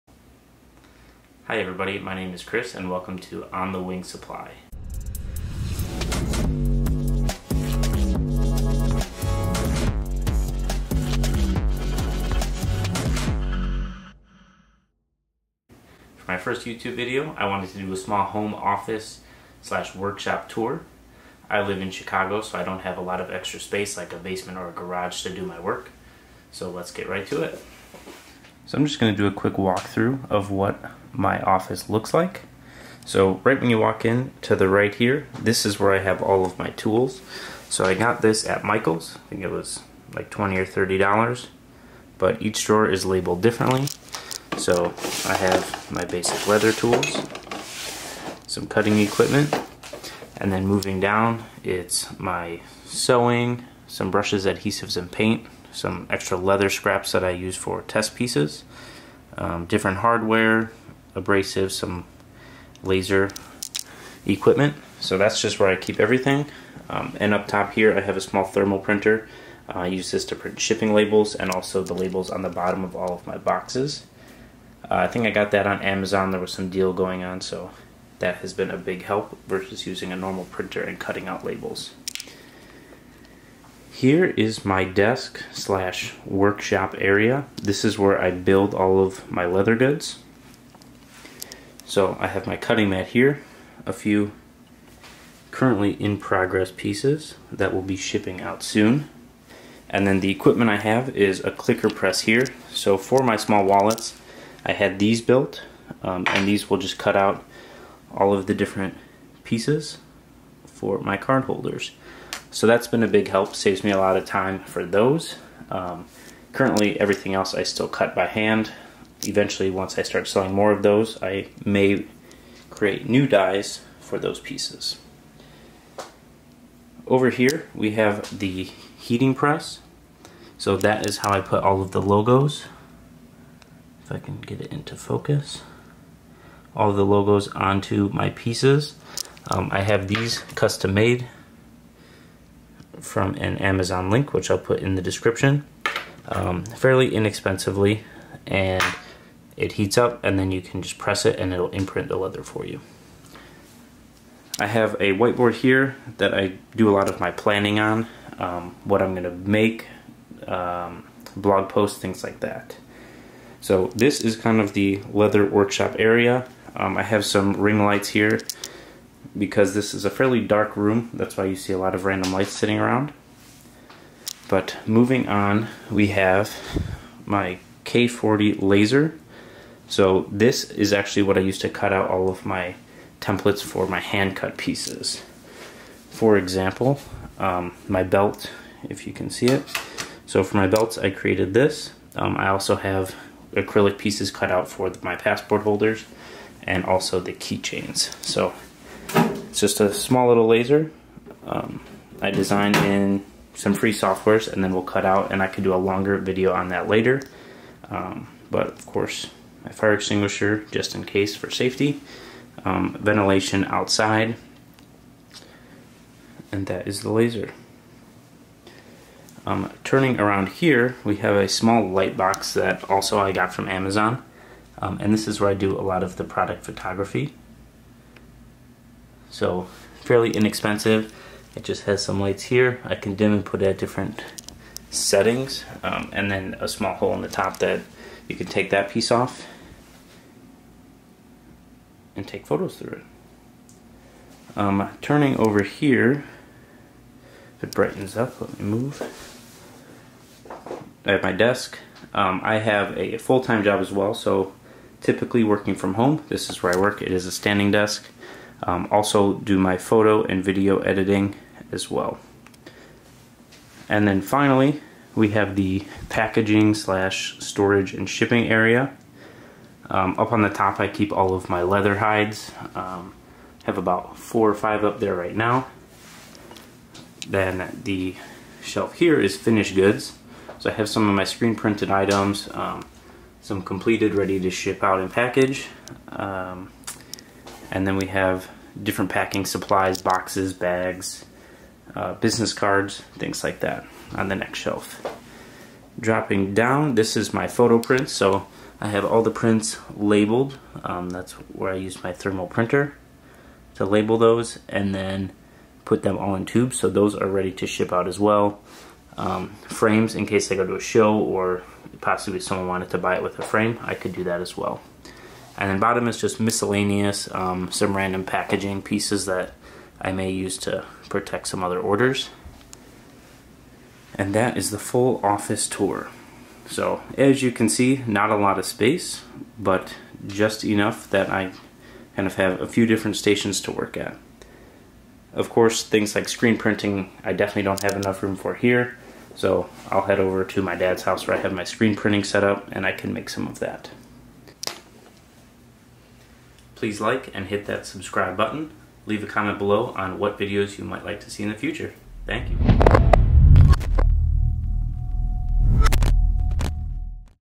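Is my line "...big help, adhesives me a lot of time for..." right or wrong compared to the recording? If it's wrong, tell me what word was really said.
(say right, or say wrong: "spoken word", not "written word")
wrong: "saves", not "adhesives".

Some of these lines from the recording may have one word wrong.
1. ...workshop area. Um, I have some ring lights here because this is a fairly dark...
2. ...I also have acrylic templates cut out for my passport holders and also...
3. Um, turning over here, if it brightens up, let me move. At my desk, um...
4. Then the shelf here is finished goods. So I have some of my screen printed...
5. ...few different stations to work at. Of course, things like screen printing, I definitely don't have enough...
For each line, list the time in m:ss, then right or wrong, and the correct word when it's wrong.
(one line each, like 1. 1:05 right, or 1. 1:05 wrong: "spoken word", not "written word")
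1. 2:45 right
2. 3:12 wrong: "pieces", not "templates"
3. 4:04 right
4. 4:37 right
5. 5:32 right.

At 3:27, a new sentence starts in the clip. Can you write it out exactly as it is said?
Um, but of course, my fire extinguisher just in case for safety, um, ventilation outside, and that is the laser.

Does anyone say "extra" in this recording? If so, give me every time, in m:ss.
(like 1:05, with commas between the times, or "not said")
0:23, 0:56.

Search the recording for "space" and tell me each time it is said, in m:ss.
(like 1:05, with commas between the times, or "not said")
0:23, 5:28.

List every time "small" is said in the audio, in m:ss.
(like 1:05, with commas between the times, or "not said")
0:17, 1:08, 1:43, 3:19, 3:41, 3:56.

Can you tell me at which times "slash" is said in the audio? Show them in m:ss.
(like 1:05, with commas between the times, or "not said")
0:19, 1:25, 4:26.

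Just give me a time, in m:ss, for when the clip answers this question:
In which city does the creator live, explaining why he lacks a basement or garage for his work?
0:21.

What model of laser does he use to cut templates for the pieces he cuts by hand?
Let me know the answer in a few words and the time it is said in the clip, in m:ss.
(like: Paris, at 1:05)
K40, at 2:57.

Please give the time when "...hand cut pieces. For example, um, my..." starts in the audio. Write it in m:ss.
3:03.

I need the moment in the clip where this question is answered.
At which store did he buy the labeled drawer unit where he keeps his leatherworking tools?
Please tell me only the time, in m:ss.
0:38.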